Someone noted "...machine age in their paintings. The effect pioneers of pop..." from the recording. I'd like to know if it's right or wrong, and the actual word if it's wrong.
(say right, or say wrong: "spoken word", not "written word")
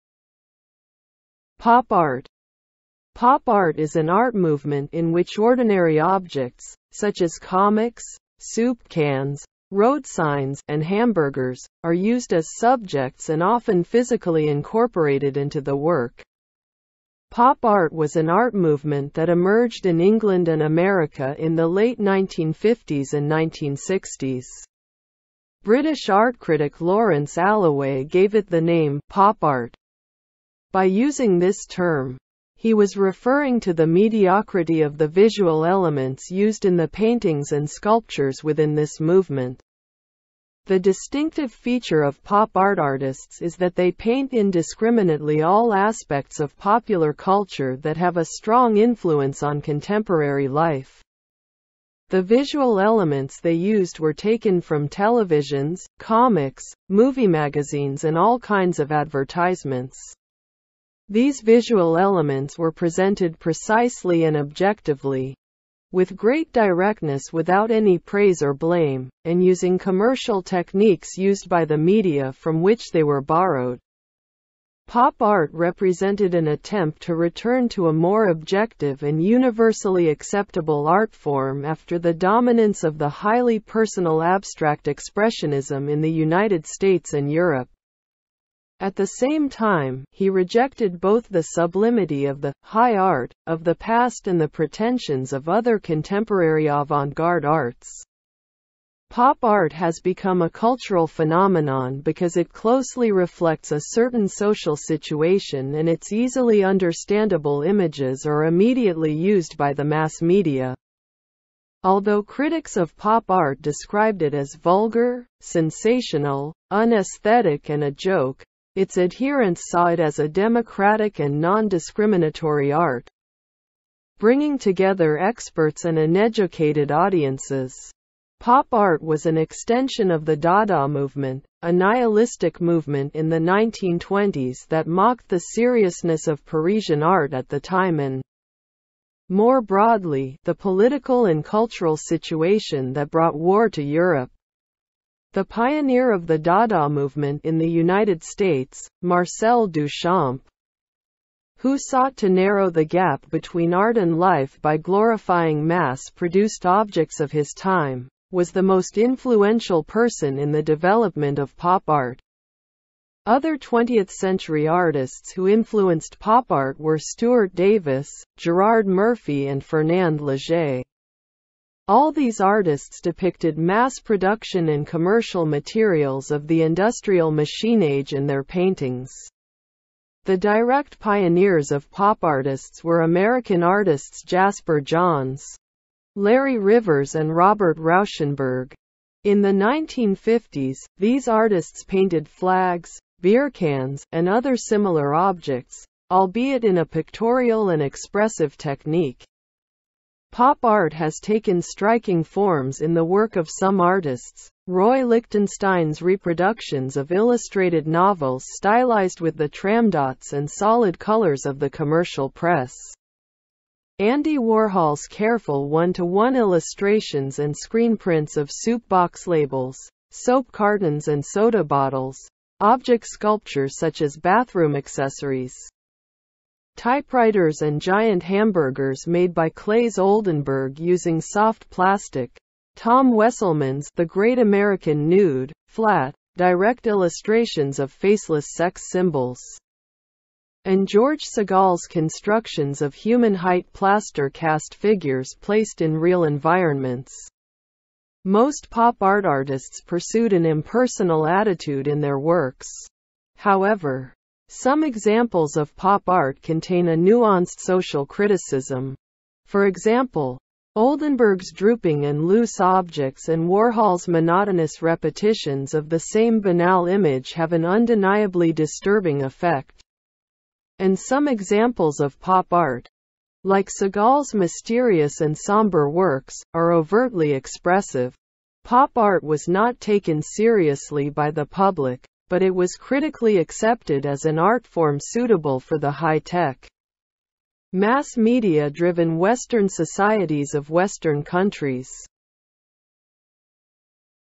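wrong: "direct", not "effect".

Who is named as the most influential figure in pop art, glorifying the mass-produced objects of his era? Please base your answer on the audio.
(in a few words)
Marcel Duchamp.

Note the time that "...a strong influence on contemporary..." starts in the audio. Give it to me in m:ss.
0:48.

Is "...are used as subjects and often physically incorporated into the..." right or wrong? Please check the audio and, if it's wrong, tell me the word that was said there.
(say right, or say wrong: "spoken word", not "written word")
right.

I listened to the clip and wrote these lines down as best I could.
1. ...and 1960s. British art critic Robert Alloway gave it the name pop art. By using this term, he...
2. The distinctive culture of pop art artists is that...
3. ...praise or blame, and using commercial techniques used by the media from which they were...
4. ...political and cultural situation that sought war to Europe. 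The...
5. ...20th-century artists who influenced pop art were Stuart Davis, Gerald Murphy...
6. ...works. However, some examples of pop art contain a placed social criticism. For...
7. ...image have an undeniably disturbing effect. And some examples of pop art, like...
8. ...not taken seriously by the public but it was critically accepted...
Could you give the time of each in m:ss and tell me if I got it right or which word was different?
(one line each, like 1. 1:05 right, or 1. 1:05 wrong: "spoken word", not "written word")
1. 0:23 wrong: "Lawrence", not "Robert"
2. 0:40 wrong: "feature", not "culture"
3. 1:07 right
4. 2:20 wrong: "brought", not "sought"
5. 2:43 right
6. 4:12 wrong: "nuanced", not "placed"
7. 4:26 right
8. 4:39 right.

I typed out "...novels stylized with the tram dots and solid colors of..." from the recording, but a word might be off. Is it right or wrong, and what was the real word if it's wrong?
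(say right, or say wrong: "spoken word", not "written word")
right.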